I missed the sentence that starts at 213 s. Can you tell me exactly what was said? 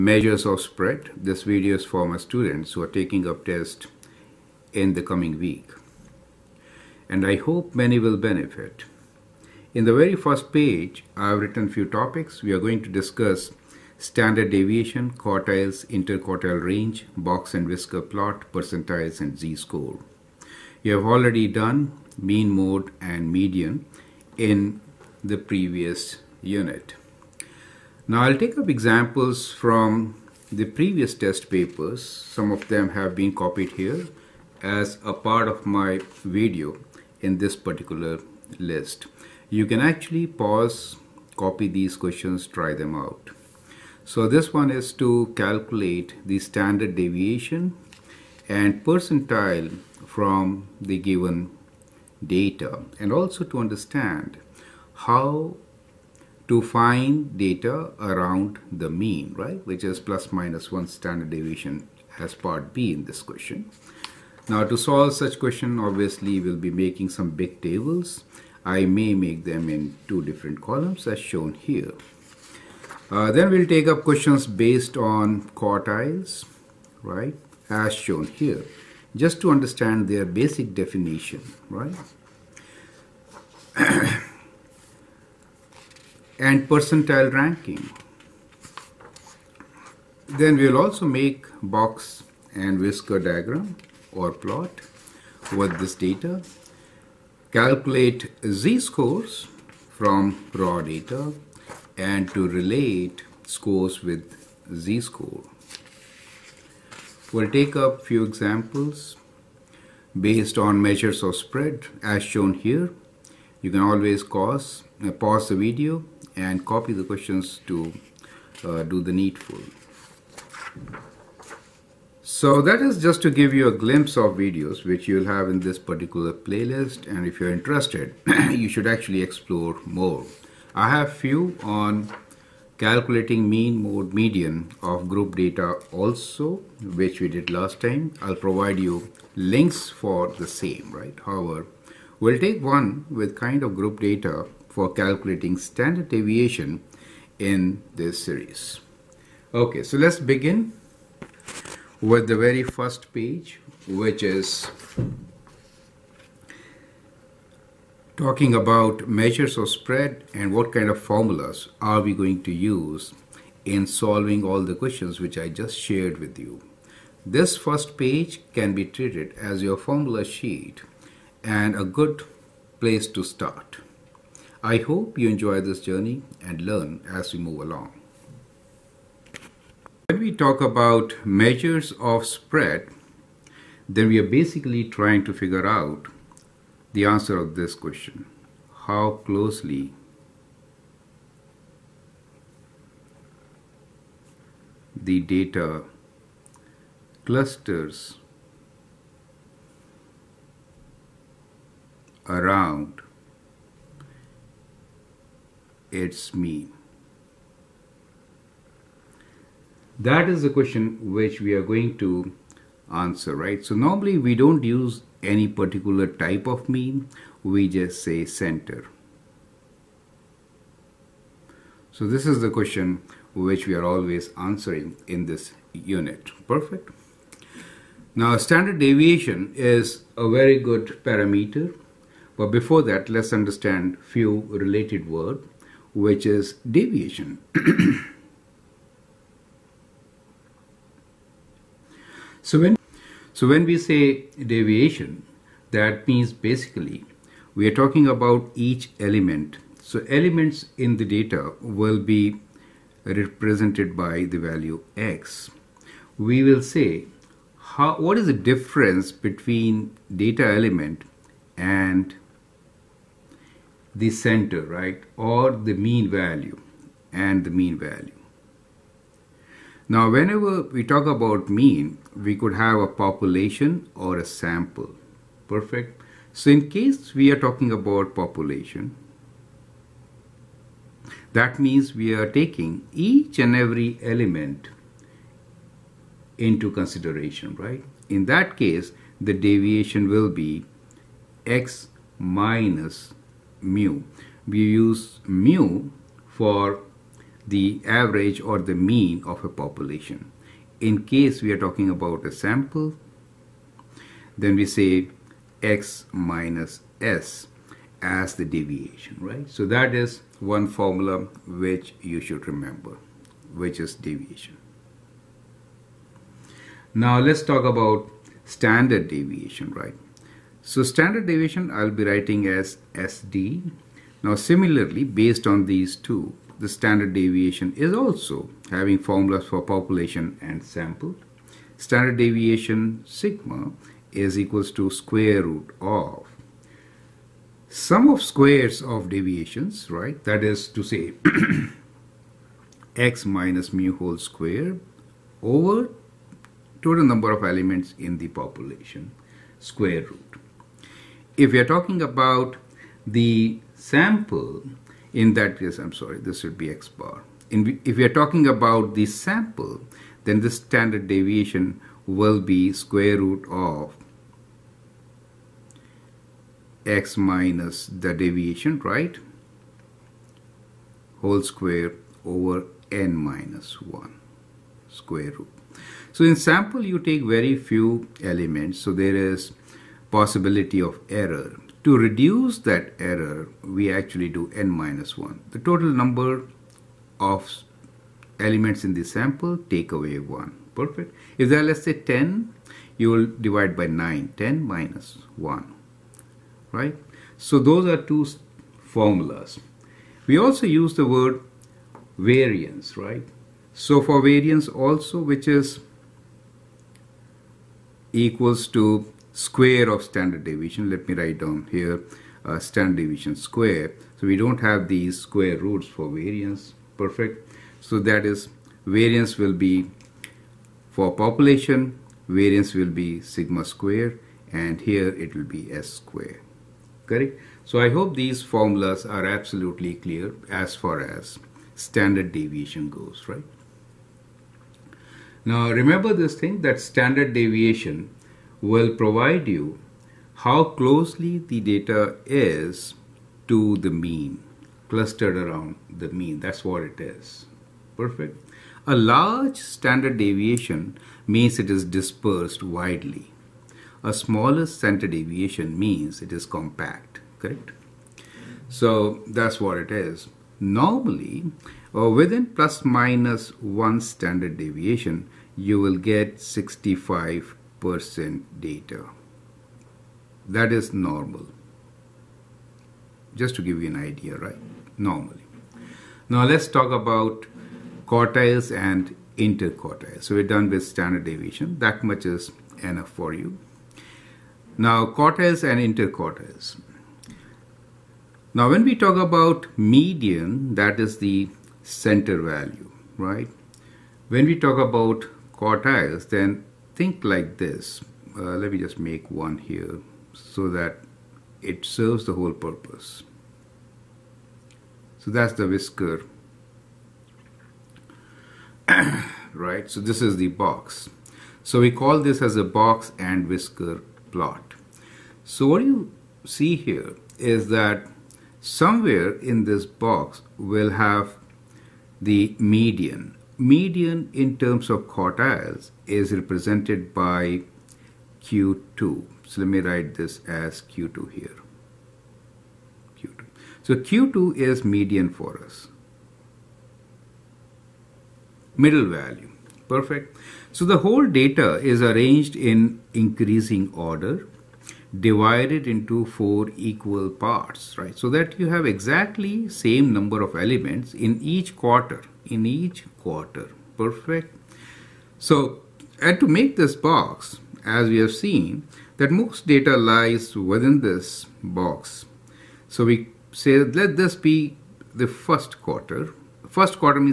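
So normally we don't use any particular type of mean, we just say center.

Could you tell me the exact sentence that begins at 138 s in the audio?
I'll provide you links for the same right.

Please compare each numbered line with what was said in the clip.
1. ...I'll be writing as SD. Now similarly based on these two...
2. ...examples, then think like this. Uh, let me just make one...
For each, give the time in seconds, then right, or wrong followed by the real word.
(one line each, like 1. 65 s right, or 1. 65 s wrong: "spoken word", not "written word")
1. 321 s right
2. 495 s wrong: "quartiles", not "examples".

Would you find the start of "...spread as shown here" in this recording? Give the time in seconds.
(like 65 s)
111 s.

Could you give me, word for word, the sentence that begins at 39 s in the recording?
You can actually pause, copy these questions, try them out.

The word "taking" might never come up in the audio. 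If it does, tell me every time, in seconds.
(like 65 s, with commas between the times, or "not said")
2 s, 282 s.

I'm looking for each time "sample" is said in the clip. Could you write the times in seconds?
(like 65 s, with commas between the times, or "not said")
274 s, 302 s, 330 s, 353 s, 359 s, 376 s, 389 s.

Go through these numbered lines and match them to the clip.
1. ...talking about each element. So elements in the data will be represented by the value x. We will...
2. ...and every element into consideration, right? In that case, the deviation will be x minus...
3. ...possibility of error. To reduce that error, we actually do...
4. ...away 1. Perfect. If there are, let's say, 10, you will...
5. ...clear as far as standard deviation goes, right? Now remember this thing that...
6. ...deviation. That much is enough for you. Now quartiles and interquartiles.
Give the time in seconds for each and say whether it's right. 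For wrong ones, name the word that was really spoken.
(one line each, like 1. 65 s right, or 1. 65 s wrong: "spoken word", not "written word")
1. 247 s right
2. 283 s right
3. 380 s right
4. 389 s right
5. 429 s right
6. 481 s right.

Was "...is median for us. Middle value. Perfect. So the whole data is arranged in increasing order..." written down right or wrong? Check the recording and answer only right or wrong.
right.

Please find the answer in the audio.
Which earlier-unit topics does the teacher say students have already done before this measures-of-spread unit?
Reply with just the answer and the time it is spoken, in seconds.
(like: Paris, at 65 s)
mean mode and median, at 22 s.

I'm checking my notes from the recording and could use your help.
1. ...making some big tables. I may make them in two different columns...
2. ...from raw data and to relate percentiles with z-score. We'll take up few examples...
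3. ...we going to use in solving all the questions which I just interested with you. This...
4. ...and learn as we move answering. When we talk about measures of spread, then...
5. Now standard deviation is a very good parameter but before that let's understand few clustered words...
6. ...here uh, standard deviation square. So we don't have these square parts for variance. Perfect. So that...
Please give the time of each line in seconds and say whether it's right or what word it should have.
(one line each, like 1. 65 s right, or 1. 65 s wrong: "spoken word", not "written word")
1. 66 s right
2. 99 s wrong: "scores", not "percentiles"
3. 161 s wrong: "shared", not "interested"
4. 176 s wrong: "along", not "answering"
5. 228 s wrong: "related", not "clustered"
6. 411 s wrong: "roots", not "parts".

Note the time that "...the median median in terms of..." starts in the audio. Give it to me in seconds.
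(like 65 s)
522 s.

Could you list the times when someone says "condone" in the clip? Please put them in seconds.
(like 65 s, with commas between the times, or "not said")
not said.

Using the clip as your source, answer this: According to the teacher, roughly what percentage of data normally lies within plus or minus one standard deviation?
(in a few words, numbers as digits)
65 percent.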